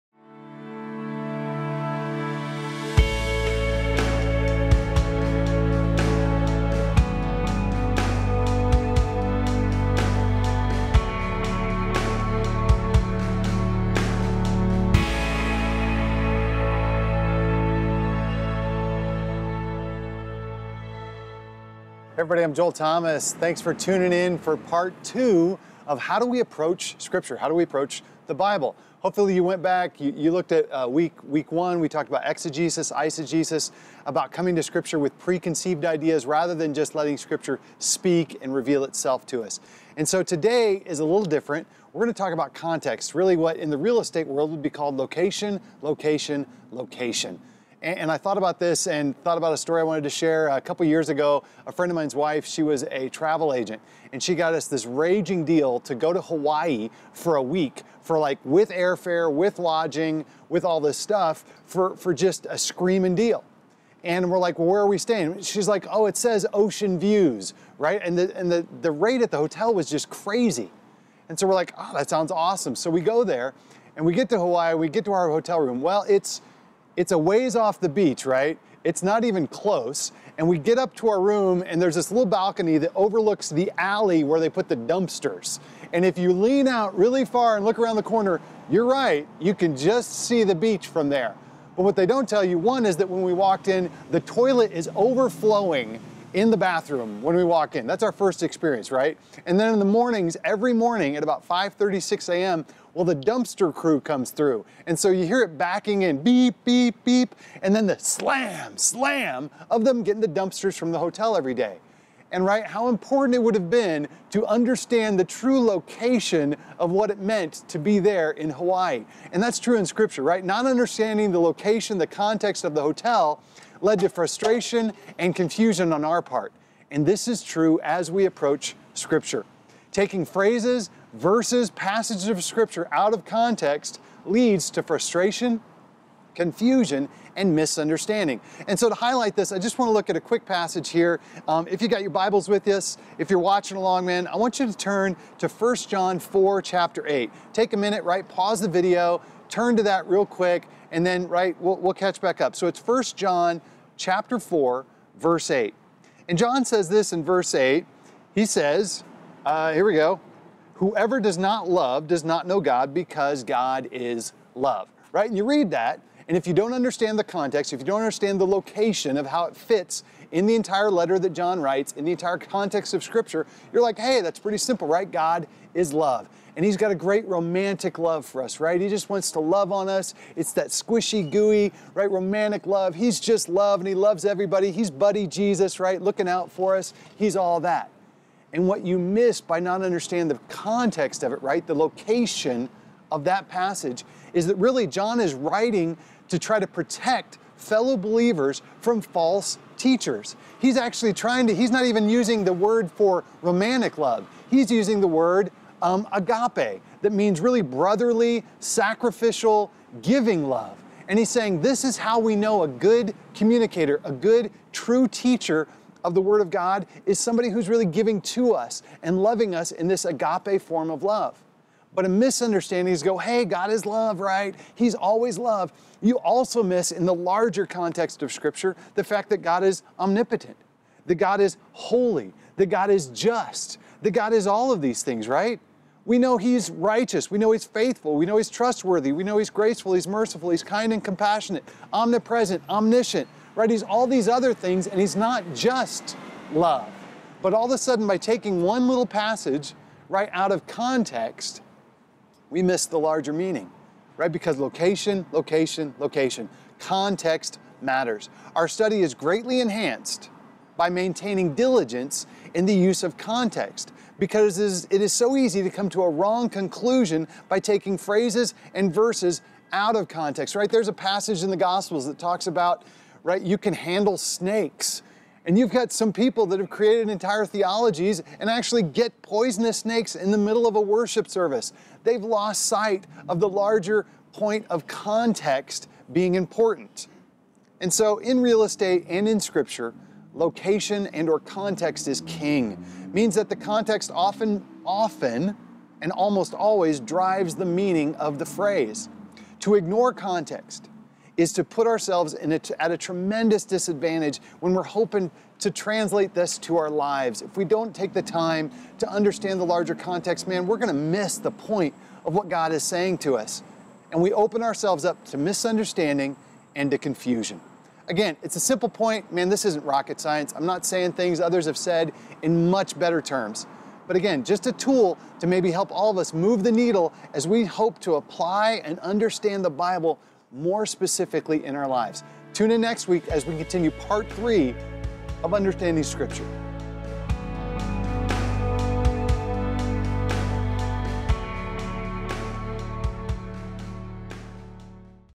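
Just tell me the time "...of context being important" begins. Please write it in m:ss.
4:44.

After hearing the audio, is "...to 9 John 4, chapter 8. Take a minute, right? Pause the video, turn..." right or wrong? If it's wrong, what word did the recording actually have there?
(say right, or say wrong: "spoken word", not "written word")
wrong: "1", not "9".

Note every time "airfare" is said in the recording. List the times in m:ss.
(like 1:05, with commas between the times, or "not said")
0:58.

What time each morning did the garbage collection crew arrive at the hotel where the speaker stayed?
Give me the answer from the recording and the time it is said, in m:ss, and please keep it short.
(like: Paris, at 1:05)
5:30 a.m., at 1:41.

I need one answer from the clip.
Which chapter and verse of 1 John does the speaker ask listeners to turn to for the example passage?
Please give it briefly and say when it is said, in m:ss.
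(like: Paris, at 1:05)
Chapter 4, verse 8, at 2:32.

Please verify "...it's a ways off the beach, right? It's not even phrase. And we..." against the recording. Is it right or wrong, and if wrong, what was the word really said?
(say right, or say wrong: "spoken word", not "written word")
wrong: "close", not "phrase".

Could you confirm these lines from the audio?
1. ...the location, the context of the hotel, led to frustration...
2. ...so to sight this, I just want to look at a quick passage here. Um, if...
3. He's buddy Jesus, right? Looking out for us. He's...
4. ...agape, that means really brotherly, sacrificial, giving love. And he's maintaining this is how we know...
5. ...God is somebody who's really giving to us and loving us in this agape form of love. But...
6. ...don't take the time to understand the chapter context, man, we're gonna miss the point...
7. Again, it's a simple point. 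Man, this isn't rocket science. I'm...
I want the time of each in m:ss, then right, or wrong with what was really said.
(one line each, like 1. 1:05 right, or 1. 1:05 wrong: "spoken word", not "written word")
1. 2:01 right
2. 2:18 wrong: "highlight", not "sight"
3. 3:04 right
4. 3:26 wrong: "saying", not "maintaining"
5. 3:36 right
6. 5:07 wrong: "larger", not "chapter"
7. 5:18 right.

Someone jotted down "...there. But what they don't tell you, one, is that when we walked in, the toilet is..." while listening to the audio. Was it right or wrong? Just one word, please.
right.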